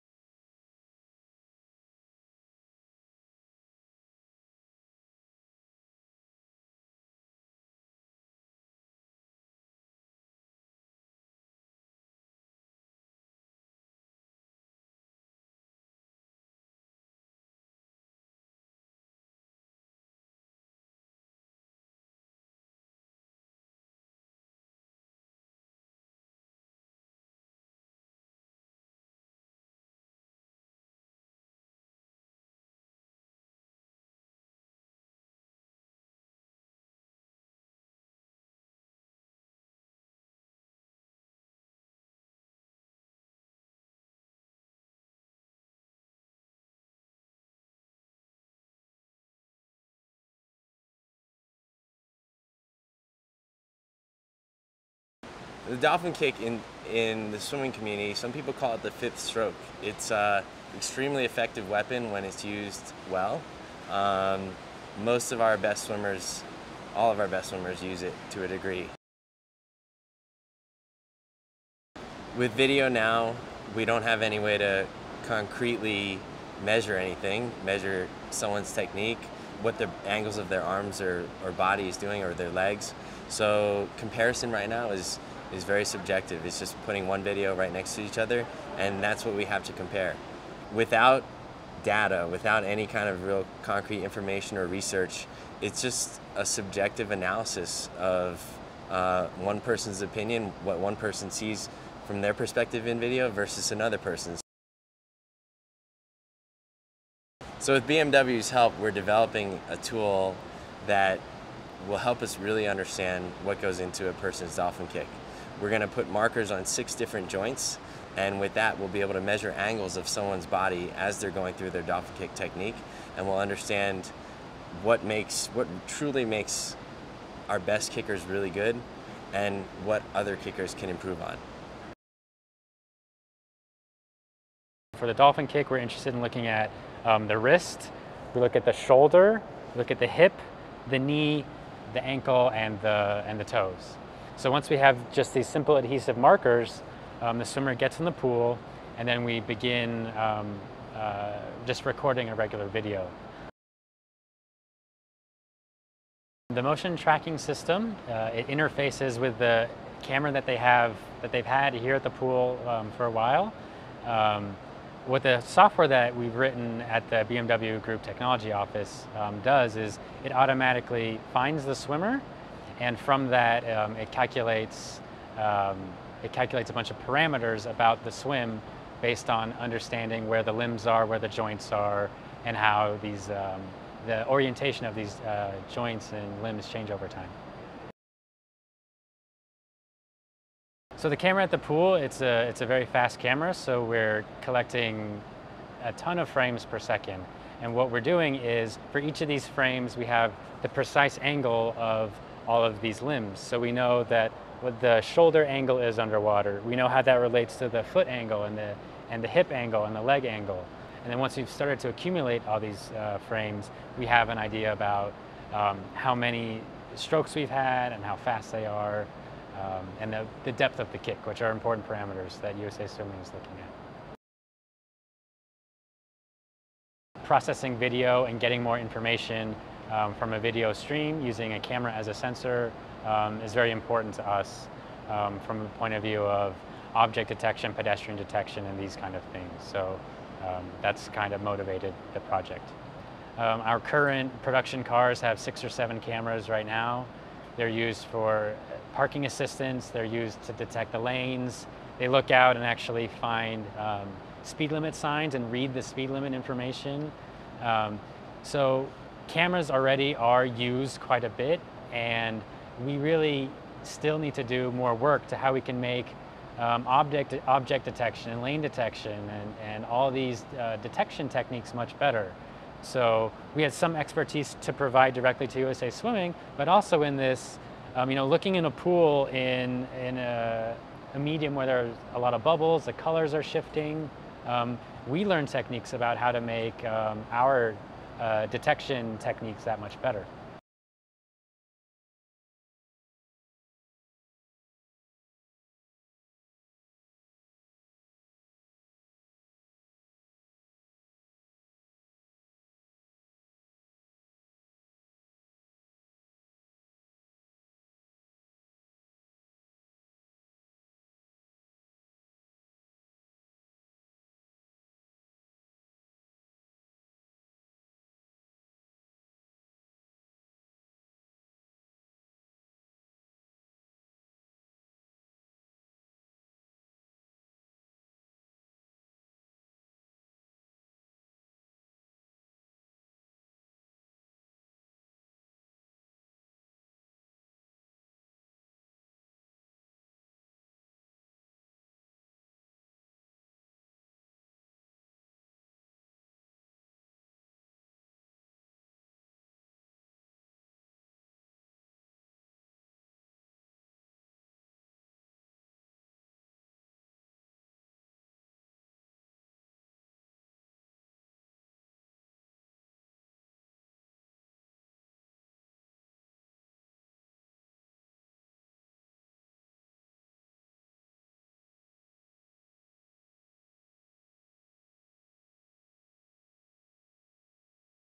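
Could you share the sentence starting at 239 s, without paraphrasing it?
So um, that's kind of motivated the project.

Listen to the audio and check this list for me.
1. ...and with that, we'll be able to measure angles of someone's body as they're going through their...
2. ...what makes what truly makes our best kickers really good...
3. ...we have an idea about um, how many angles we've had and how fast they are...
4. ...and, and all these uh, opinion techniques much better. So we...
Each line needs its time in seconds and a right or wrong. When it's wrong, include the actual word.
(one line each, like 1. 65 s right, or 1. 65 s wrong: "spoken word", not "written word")
1. 118 s right
2. 124 s right
3. 213 s wrong: "strokes", not "angles"
4. 269 s wrong: "detection", not "opinion".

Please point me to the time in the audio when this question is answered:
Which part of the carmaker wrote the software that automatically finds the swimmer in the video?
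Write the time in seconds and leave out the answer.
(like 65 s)
167 s.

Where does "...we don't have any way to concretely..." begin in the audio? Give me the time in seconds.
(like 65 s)
73 s.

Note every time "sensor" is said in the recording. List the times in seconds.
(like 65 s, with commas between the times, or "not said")
232 s.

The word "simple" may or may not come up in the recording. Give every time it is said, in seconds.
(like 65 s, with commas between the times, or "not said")
145 s.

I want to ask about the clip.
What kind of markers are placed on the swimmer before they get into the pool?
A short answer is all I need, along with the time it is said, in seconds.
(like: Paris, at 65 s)
adhesive markers, at 145 s.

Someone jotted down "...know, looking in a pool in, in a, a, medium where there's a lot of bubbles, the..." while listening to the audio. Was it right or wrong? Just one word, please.
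right.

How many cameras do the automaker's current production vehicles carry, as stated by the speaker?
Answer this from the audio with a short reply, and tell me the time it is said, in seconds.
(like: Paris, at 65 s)
6 or 7, at 245 s.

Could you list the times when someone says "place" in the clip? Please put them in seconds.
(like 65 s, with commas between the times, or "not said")
not said.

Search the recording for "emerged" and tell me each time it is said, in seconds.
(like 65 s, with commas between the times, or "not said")
not said.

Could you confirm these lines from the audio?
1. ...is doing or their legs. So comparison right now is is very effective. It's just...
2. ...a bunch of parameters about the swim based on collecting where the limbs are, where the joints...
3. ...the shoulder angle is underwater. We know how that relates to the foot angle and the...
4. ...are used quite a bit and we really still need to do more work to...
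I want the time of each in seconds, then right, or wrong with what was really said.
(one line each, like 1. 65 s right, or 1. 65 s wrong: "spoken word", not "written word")
1. 81 s wrong: "subjective", not "effective"
2. 176 s wrong: "understanding", not "collecting"
3. 204 s right
4. 260 s right.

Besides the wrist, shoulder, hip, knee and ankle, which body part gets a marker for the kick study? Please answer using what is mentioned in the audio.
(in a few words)
toes.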